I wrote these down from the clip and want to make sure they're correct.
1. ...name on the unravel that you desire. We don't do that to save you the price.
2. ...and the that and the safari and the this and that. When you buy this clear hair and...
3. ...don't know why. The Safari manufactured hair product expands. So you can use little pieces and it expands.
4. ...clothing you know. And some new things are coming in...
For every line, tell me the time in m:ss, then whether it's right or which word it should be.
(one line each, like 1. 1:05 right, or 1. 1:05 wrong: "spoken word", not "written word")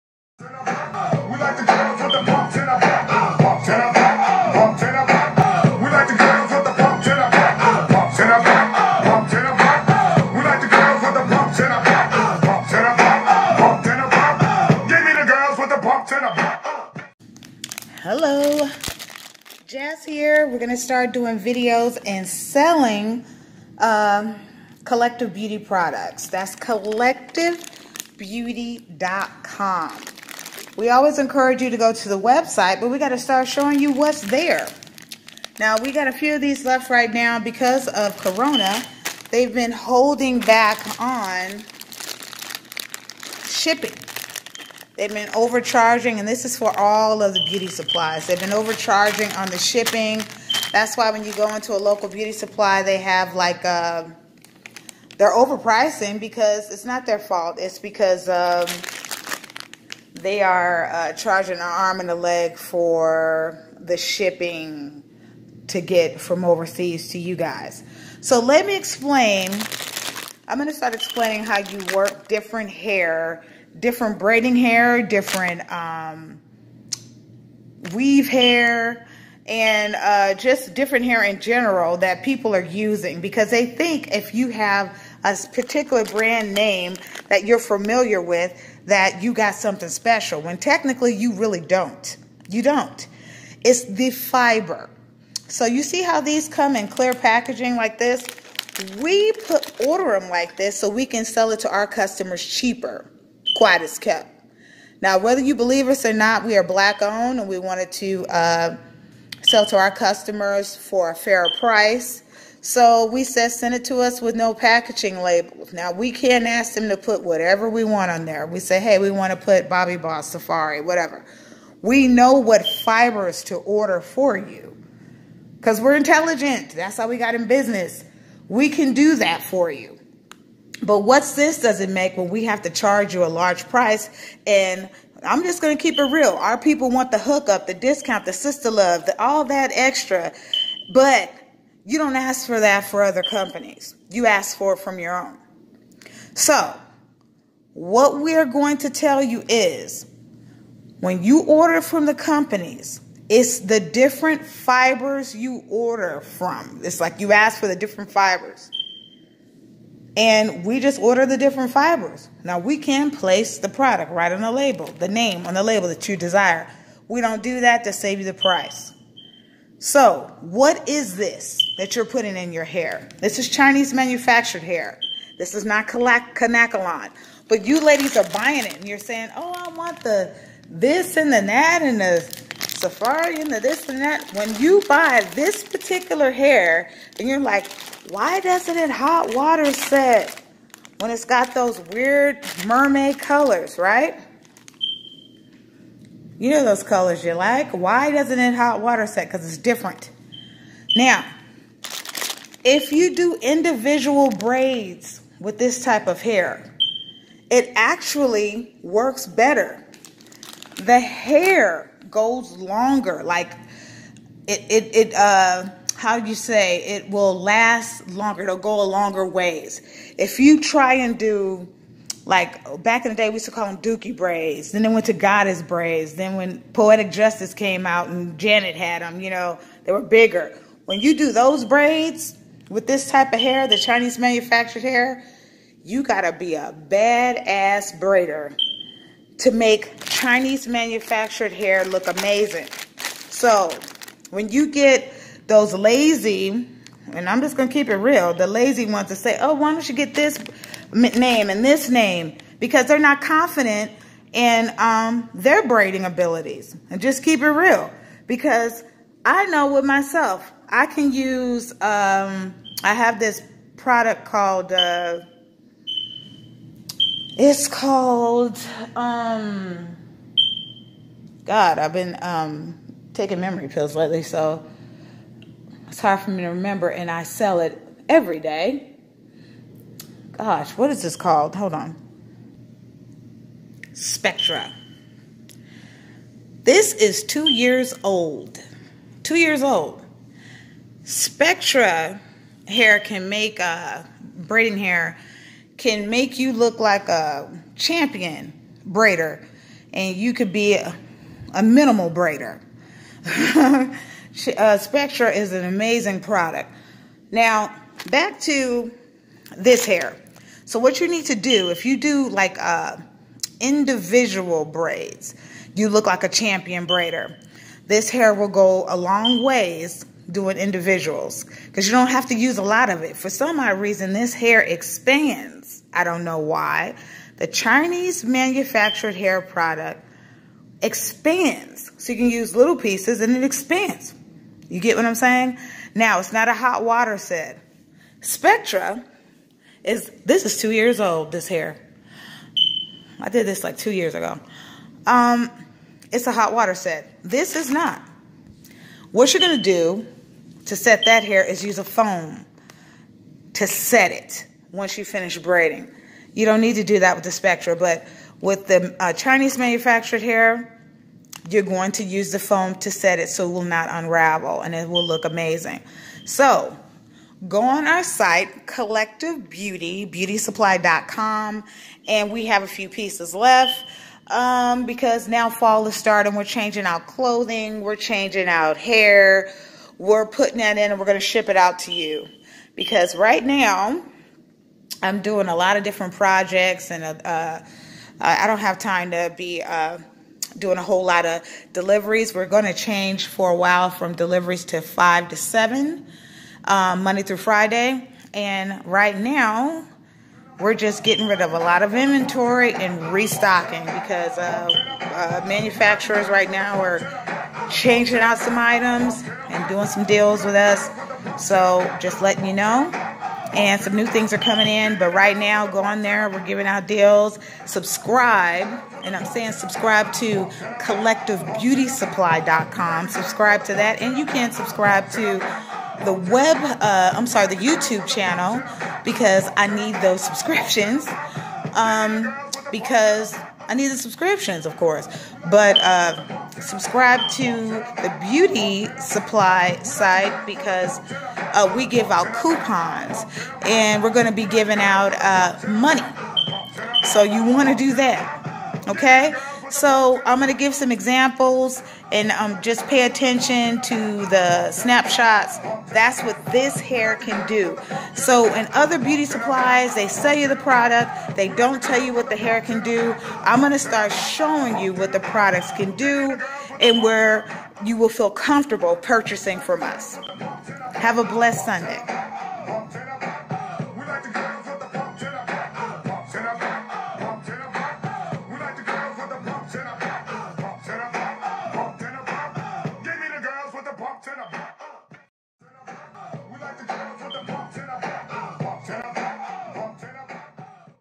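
1. 2:45 wrong: "label", not "unravel"
2. 3:01 wrong: "particular", not "clear"
3. 5:26 wrong: "Chinese", not "Safari"
4. 6:52 wrong: "letting", not "clothing".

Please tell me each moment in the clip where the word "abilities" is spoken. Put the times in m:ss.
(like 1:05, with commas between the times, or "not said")
4:16.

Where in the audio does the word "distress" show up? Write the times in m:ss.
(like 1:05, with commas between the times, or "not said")
not said.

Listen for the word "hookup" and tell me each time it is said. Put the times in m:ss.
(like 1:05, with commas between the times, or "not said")
2:17.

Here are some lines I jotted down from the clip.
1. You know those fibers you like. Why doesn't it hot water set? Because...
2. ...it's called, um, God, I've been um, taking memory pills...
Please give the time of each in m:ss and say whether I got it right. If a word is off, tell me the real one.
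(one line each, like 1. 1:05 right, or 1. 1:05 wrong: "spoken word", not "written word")
1. 3:16 wrong: "colors", not "fibers"
2. 4:27 right.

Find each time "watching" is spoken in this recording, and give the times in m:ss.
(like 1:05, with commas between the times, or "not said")
not said.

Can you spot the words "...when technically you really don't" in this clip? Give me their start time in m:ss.
1:30.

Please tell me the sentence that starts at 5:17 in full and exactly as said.
This hair will go a long ways doing individuals because you don't have to use a lot of it.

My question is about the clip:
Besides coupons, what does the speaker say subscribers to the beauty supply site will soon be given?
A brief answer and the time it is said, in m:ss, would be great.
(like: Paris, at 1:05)
Money, at 7:25.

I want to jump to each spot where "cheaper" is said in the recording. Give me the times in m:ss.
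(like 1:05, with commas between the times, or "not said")
1:42.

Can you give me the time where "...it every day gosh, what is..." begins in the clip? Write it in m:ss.
4:37.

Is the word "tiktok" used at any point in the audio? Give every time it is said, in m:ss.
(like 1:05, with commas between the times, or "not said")
not said.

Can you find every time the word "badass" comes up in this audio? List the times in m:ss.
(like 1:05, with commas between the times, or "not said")
3:56.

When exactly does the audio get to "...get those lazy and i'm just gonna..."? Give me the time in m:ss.
4:04.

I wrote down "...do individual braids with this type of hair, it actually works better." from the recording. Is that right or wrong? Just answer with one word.
right.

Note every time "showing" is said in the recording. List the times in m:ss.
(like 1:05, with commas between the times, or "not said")
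0:33, 7:44.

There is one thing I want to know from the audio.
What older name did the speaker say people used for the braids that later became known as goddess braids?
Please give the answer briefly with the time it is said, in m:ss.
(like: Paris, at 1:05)
Dookie braids, at 3:43.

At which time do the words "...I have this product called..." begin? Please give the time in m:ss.
4:22.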